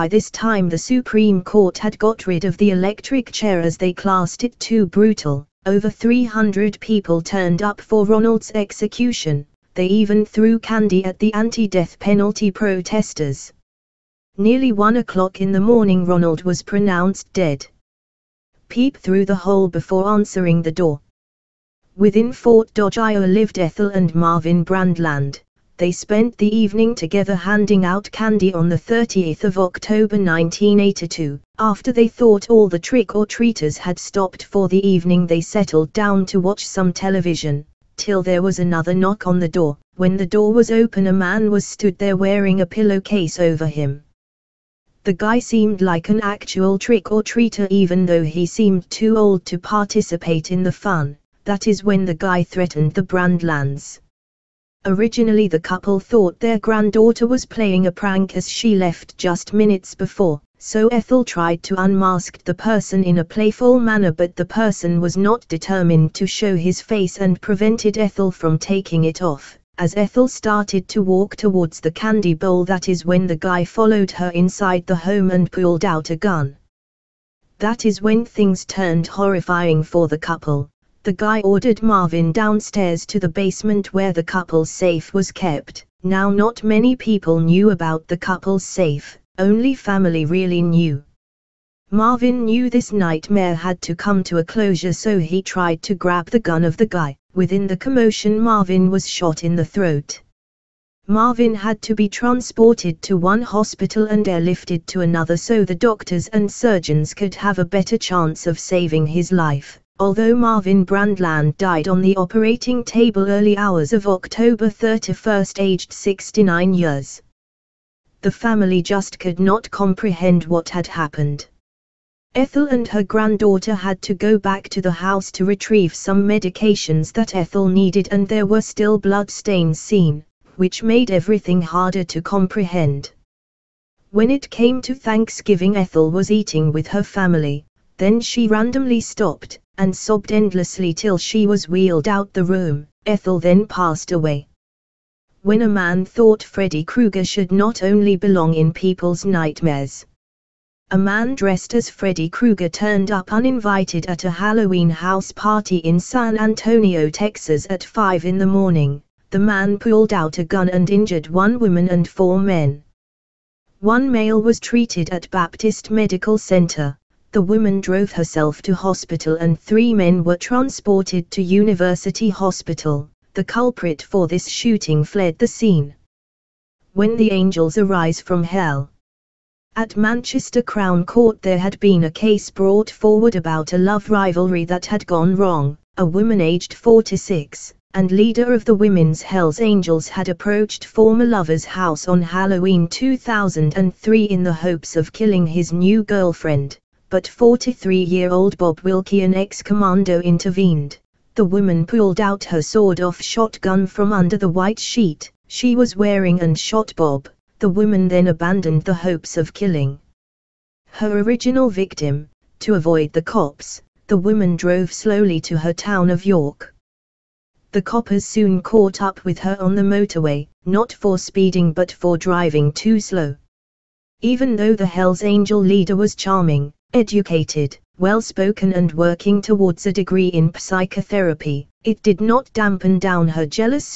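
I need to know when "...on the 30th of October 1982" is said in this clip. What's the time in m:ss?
0:28.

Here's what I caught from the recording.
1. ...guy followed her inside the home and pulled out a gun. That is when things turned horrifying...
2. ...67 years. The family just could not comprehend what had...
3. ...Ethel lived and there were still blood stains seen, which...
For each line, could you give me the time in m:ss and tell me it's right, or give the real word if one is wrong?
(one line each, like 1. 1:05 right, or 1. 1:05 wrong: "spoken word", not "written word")
1. 1:13 right
2. 1:55 wrong: "69", not "67"
3. 2:07 wrong: "needed", not "lived".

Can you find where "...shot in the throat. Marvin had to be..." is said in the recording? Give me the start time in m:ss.
1:39.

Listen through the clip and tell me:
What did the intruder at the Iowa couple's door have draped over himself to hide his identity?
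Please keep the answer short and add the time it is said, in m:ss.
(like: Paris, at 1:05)
a pillowcase, at 0:42.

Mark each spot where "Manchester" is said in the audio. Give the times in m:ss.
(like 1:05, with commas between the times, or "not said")
2:59.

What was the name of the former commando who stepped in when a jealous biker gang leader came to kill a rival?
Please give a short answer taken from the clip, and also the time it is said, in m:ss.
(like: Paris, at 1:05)
Bob Wilkie, at 3:18.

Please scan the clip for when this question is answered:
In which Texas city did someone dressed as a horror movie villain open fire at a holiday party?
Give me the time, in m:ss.
2:35.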